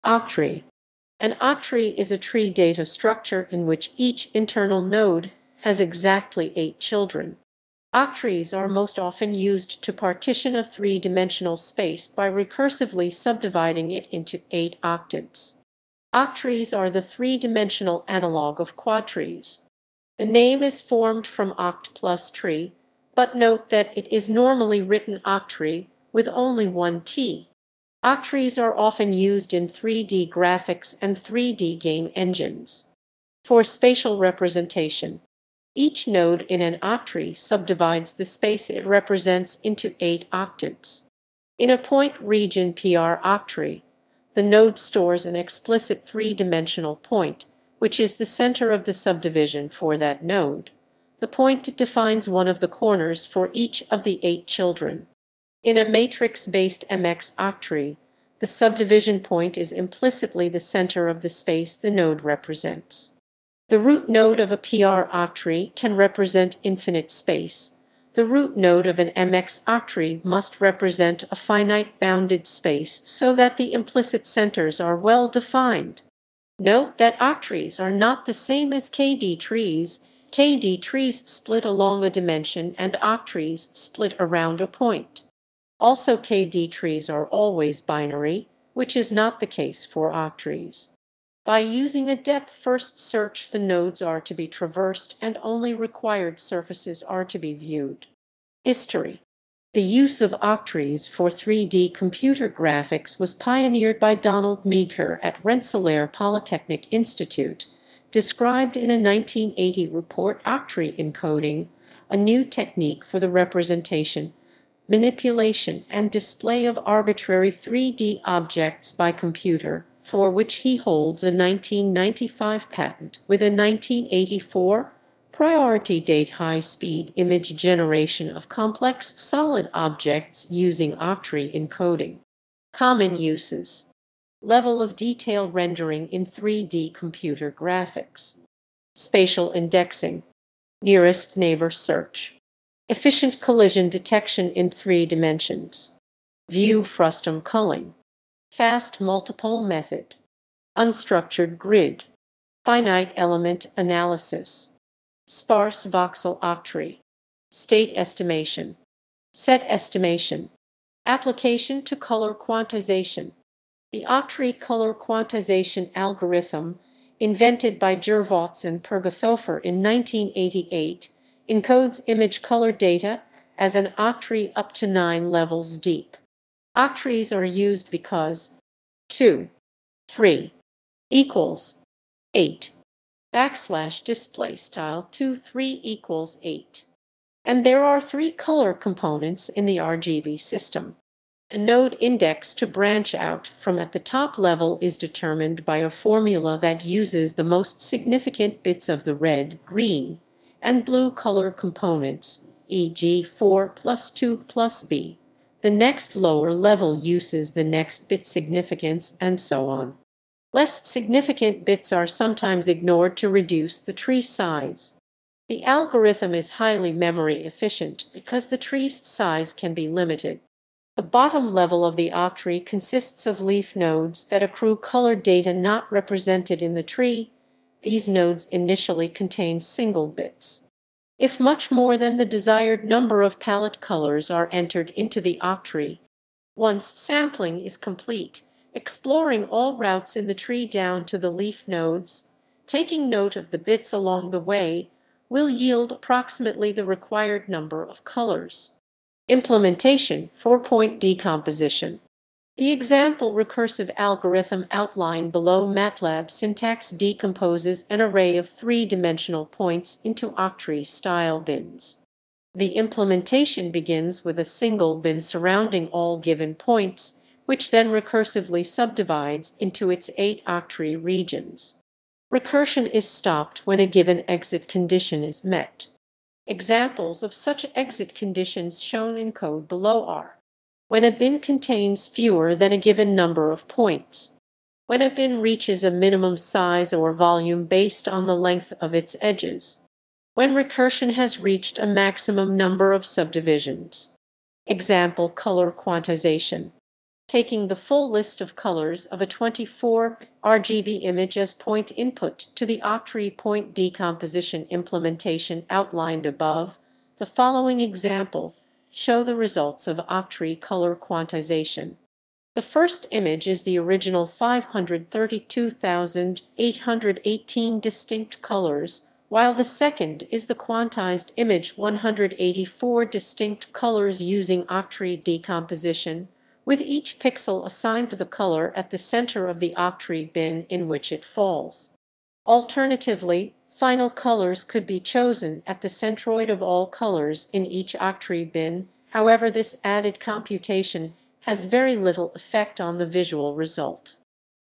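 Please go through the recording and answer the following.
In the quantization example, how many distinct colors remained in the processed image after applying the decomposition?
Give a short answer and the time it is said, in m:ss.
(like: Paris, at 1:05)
184, at 5:21.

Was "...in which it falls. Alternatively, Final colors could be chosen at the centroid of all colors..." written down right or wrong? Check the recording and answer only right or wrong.
right.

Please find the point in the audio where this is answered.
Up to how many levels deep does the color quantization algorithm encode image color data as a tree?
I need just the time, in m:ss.
2:54.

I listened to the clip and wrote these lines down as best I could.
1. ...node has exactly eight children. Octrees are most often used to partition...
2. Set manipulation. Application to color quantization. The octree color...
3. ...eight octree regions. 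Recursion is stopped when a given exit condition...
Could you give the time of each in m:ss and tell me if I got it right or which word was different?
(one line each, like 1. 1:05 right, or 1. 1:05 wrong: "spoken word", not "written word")
1. 0:04 right
2. 2:39 wrong: "estimation", not "manipulation"
3. 4:30 right.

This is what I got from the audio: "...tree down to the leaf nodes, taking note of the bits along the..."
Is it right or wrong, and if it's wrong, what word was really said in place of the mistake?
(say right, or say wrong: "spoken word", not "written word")
right.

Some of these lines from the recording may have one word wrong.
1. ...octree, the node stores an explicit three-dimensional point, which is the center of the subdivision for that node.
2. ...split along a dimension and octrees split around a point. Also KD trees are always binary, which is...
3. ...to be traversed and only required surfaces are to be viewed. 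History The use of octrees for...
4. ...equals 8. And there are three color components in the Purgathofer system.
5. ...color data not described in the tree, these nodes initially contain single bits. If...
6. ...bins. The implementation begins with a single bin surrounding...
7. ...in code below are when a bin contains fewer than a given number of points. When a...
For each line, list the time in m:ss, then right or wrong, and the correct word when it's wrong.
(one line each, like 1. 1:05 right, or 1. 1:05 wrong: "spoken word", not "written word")
1. 0:43 right
2. 1:21 right
3. 1:34 right
4. 3:05 wrong: "RGB", not "Purgathofer"
5. 3:44 wrong: "represented", not "described"
6. 4:21 right
7. 4:39 right.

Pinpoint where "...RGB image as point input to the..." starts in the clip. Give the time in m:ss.
5:00.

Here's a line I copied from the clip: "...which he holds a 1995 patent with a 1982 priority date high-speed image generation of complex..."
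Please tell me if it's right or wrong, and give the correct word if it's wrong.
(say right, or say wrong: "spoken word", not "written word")
wrong: "1984", not "1982".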